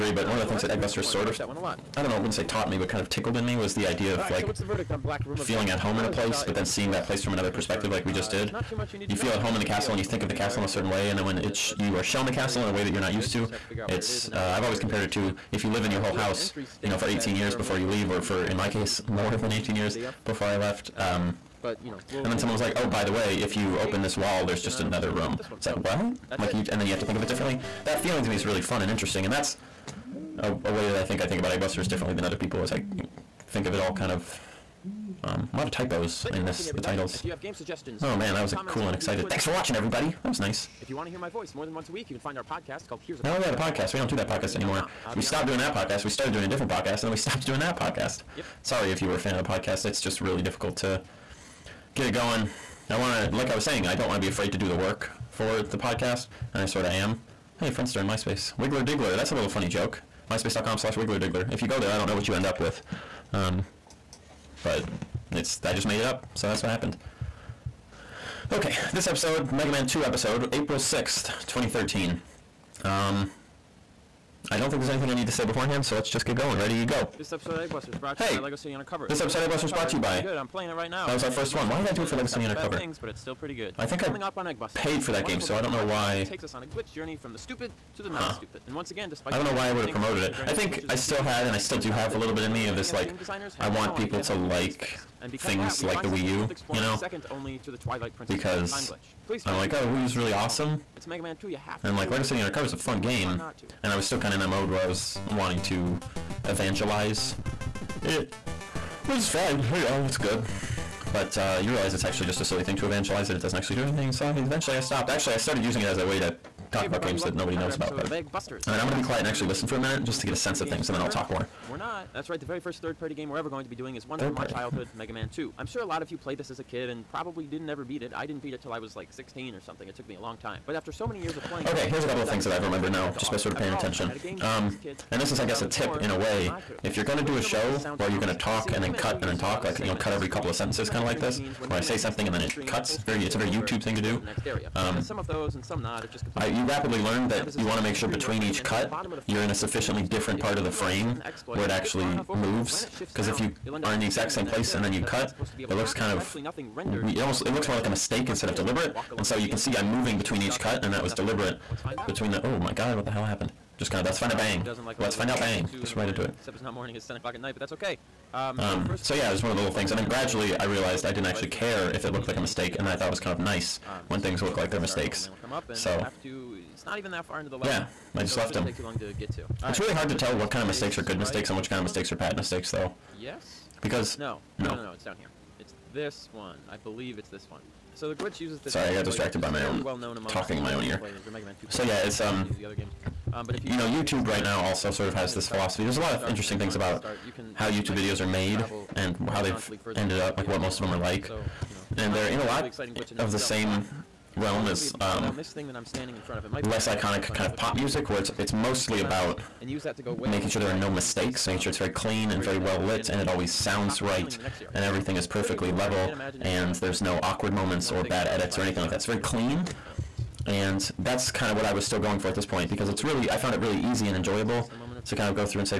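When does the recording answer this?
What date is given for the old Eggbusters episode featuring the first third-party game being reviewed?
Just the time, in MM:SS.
01:10.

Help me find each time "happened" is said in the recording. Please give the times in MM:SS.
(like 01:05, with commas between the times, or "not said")
01:06, 02:43.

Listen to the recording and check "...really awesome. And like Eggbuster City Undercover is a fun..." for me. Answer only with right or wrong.
wrong.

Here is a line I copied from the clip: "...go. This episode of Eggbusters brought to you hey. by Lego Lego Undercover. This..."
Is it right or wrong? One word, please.
wrong.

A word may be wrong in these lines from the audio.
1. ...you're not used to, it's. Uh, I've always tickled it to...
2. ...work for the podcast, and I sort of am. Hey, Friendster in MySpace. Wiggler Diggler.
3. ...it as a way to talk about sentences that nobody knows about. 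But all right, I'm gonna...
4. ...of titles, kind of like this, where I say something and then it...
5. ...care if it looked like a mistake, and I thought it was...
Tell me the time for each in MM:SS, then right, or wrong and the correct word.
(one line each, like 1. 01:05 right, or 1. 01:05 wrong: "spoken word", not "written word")
1. 00:12 wrong: "compared", not "tickled"
2. 00:54 right
3. 01:55 wrong: "games", not "sentences"
4. 02:20 wrong: "sentences", not "titles"
5. 02:51 right.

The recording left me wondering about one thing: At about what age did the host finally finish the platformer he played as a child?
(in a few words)
16.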